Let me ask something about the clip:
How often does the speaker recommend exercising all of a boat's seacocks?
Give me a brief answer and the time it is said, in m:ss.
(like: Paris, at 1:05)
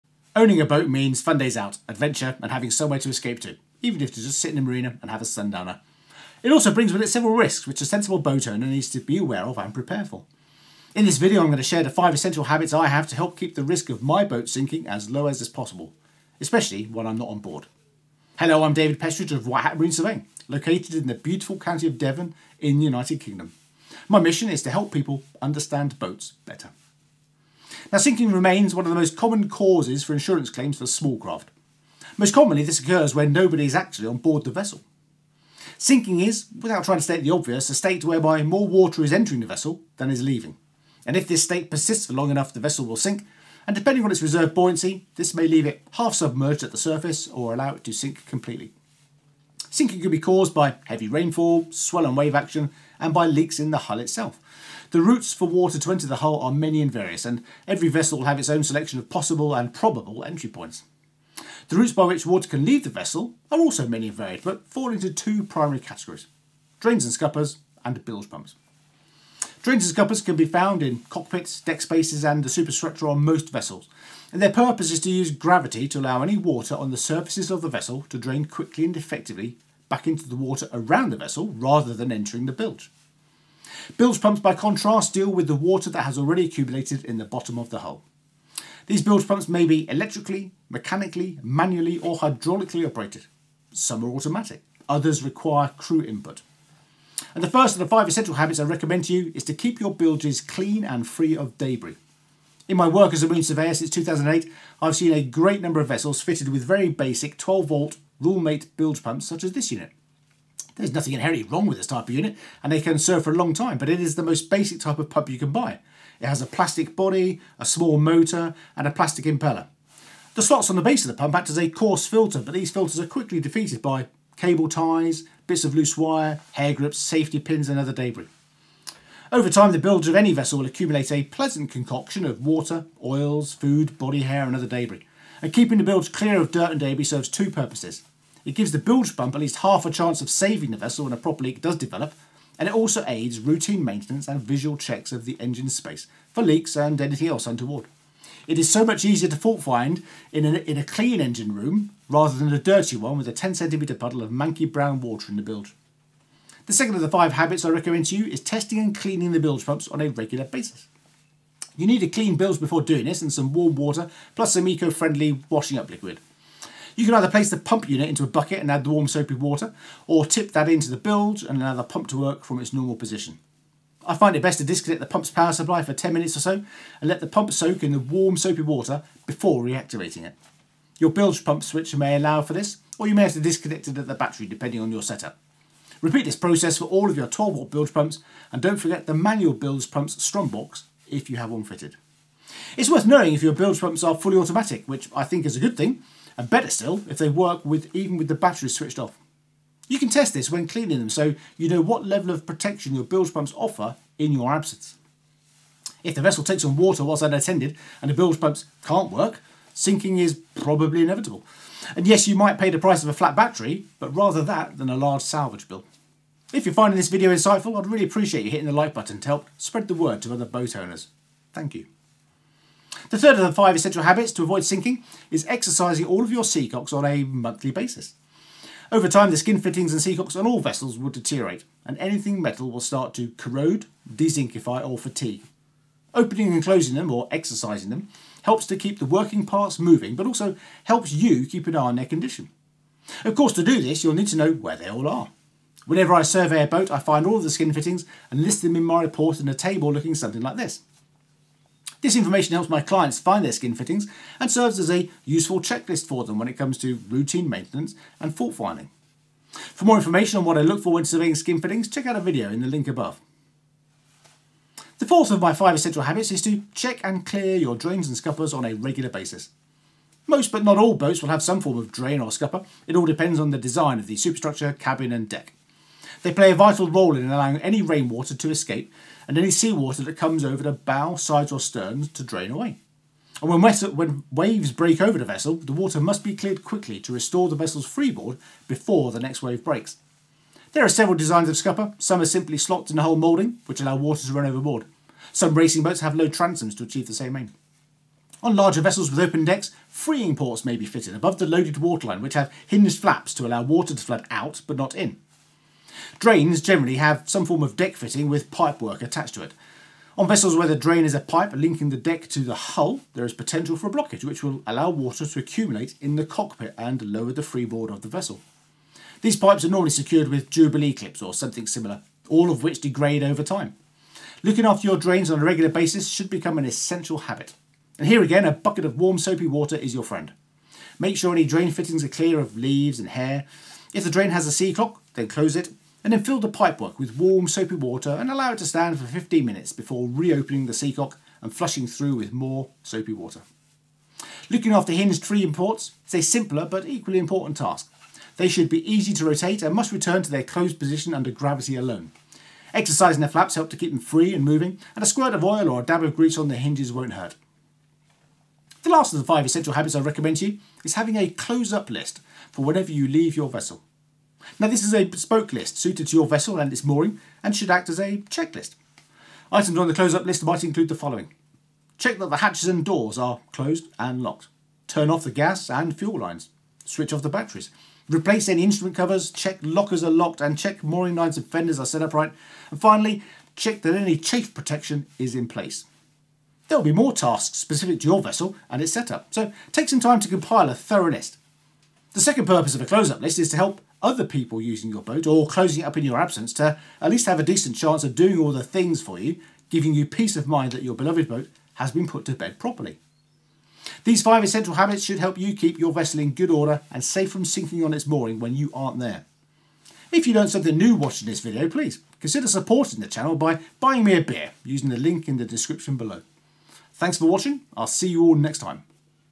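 Monthly, at 3:47.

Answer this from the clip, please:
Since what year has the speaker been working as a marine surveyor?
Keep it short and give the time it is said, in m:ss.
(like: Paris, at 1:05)
2008, at 1:43.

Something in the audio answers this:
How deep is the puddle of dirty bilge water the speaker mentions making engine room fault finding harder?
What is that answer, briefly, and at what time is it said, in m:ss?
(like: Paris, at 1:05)
10 centimetres, at 2:33.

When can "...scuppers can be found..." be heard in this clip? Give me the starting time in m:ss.
1:09.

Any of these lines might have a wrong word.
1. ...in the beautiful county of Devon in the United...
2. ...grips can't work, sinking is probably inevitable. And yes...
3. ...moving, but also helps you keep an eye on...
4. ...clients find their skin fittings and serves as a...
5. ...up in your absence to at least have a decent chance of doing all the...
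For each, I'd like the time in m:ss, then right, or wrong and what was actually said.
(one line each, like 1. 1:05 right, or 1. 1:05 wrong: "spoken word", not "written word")
1. 0:20 right
2. 3:28 wrong: "pumps", not "grips"
3. 3:59 right
4. 4:12 right
5. 6:35 right.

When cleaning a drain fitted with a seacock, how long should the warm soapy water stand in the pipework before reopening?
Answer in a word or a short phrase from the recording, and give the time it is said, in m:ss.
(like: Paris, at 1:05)
15 minutes, at 5:39.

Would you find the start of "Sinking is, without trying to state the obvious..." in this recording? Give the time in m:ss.
0:35.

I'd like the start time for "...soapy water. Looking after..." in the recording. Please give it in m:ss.
5:42.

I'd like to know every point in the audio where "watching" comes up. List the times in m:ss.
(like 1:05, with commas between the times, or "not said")
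6:50, 6:57.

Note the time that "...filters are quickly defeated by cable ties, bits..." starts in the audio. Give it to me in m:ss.
2:02.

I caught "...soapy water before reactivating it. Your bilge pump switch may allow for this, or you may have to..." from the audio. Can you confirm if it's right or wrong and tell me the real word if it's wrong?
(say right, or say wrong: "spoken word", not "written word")
right.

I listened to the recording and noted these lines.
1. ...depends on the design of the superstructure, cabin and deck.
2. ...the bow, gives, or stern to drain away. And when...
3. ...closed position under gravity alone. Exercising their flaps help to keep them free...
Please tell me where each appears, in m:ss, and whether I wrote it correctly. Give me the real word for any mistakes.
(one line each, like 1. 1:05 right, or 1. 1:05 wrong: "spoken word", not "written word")
1. 4:33 right
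2. 4:40 wrong: "sides", not "gives"
3. 5:50 right.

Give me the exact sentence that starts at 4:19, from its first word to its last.
For more information on what I look for when surveying skin fittings, check out a video in the link above.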